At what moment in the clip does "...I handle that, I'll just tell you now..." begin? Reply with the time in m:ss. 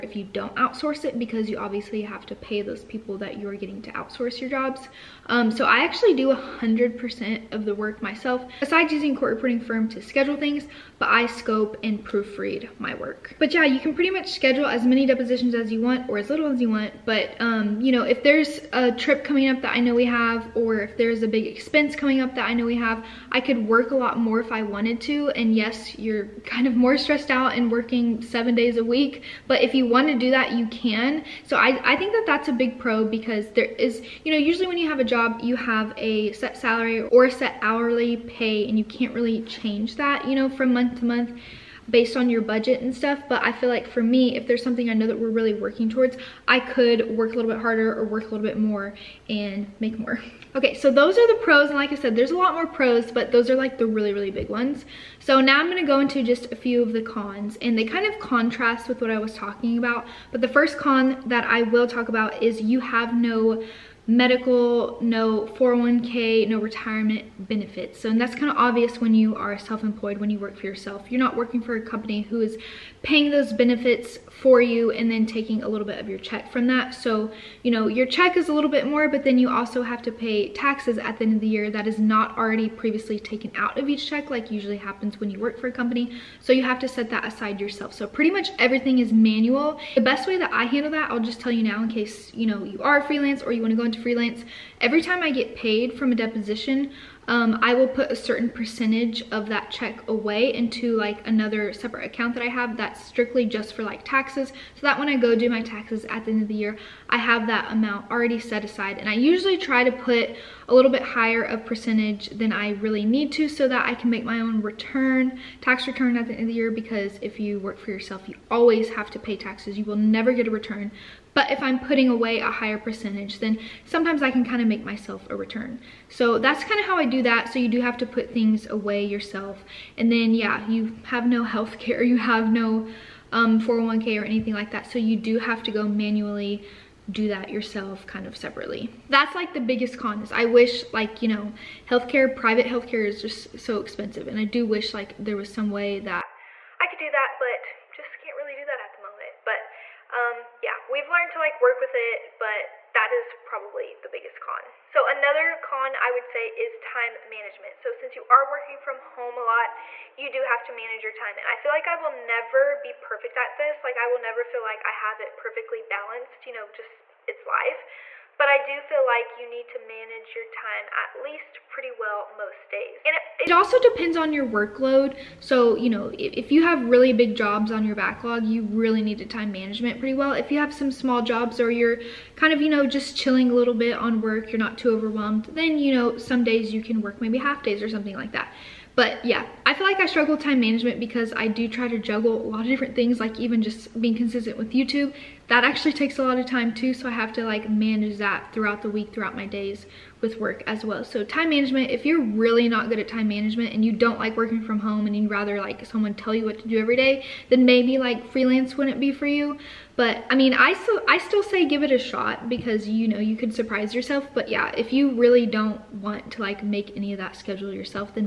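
1:30.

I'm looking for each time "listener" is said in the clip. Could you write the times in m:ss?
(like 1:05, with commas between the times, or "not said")
not said.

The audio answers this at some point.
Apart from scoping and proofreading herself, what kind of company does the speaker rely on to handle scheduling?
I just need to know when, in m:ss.
0:09.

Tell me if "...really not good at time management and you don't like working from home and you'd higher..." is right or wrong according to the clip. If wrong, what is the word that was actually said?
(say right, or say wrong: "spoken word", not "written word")
wrong: "rather", not "higher".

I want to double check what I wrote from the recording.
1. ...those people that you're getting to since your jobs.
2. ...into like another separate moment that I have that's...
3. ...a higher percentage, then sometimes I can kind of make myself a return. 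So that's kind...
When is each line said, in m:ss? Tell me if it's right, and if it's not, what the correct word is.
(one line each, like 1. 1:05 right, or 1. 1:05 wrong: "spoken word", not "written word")
1. 0:02 wrong: "outsource", not "since"
2. 1:40 wrong: "account", not "moment"
3. 2:02 right.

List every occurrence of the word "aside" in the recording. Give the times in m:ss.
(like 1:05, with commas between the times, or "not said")
1:27, 1:48.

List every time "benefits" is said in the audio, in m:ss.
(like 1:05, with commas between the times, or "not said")
1:07, 1:13.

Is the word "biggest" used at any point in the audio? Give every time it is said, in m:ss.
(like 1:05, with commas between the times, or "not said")
2:19, 2:34.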